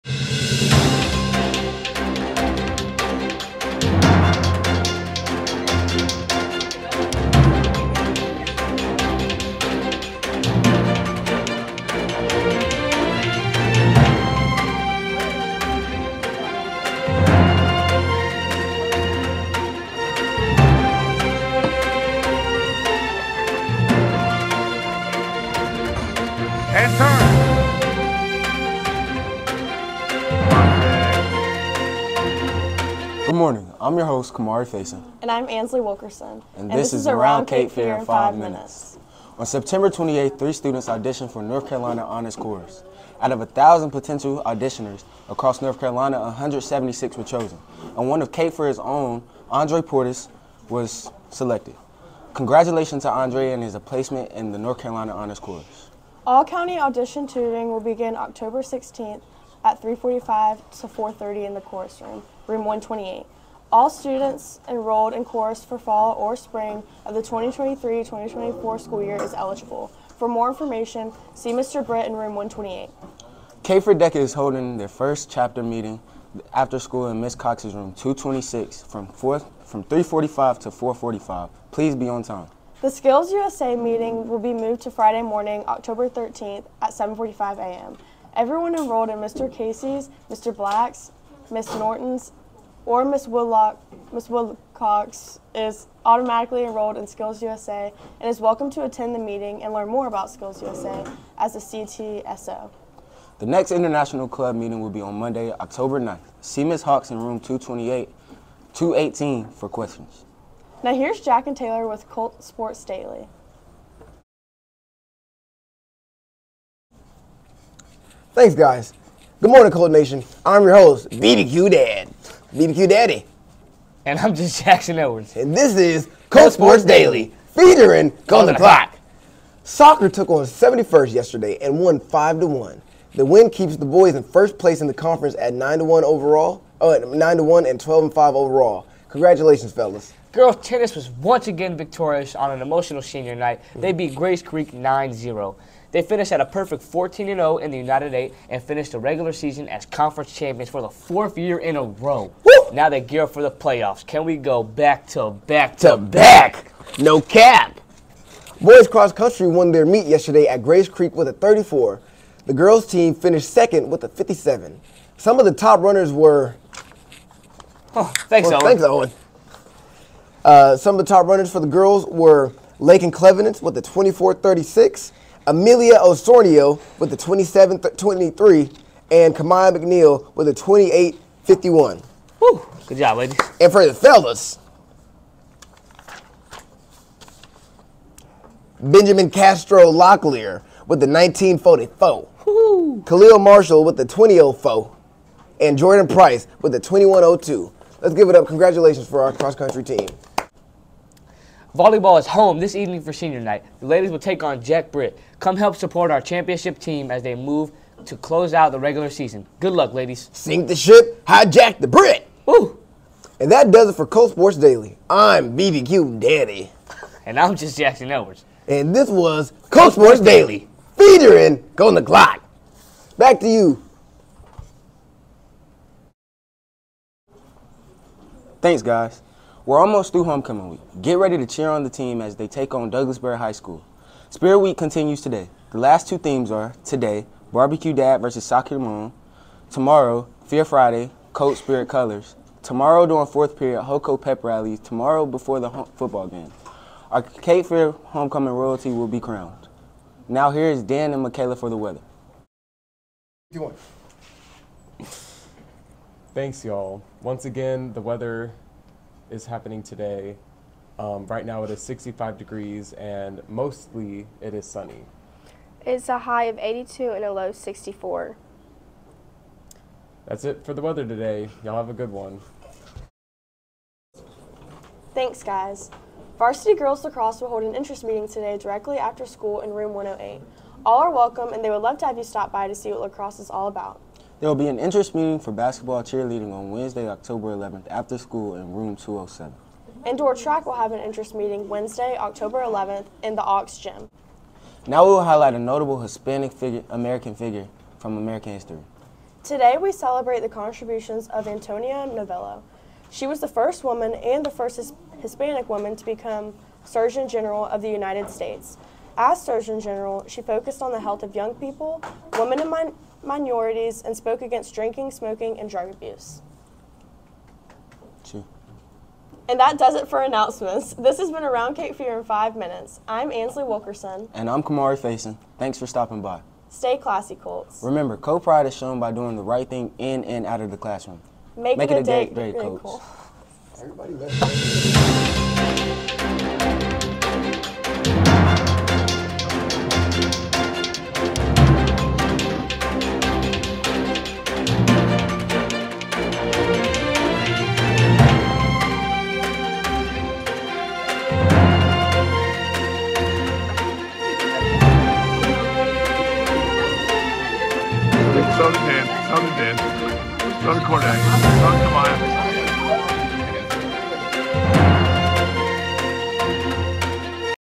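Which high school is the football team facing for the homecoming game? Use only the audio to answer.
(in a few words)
Douglas Byrd High School.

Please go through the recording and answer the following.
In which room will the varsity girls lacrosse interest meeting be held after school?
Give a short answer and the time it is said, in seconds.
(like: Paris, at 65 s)
Room 108, at 279 s.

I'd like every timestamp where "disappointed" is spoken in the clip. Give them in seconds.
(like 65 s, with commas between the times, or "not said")
not said.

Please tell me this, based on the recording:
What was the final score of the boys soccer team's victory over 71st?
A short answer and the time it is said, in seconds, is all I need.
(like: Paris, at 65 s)
5 to 1, at 131 s.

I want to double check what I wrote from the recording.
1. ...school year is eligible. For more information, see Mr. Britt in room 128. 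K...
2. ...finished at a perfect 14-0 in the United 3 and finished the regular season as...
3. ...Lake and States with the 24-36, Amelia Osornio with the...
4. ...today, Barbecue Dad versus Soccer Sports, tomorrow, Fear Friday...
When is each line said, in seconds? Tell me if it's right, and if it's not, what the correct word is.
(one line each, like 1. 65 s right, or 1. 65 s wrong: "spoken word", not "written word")
1. 68 s right
2. 146 s wrong: "8", not "3"
3. 172 s wrong: "Clevenance", not "States"
4. 236 s wrong: "Mom", not "Sports".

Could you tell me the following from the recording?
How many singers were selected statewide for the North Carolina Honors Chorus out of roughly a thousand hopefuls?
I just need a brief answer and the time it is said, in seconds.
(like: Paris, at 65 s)
176, at 46 s.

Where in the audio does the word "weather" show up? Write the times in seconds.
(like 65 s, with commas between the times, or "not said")
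251 s, 258 s, 270 s.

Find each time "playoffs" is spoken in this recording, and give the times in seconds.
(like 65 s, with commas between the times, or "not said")
153 s.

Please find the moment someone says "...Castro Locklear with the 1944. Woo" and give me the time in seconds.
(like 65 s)
189 s.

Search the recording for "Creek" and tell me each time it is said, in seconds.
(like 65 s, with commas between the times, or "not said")
144 s, 160 s.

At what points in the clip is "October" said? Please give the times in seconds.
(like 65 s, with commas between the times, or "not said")
58 s, 85 s, 105 s, 287 s, 292 s.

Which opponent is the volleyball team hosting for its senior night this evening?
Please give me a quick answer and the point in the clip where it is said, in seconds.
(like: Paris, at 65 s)
Jack Britt, at 204 s.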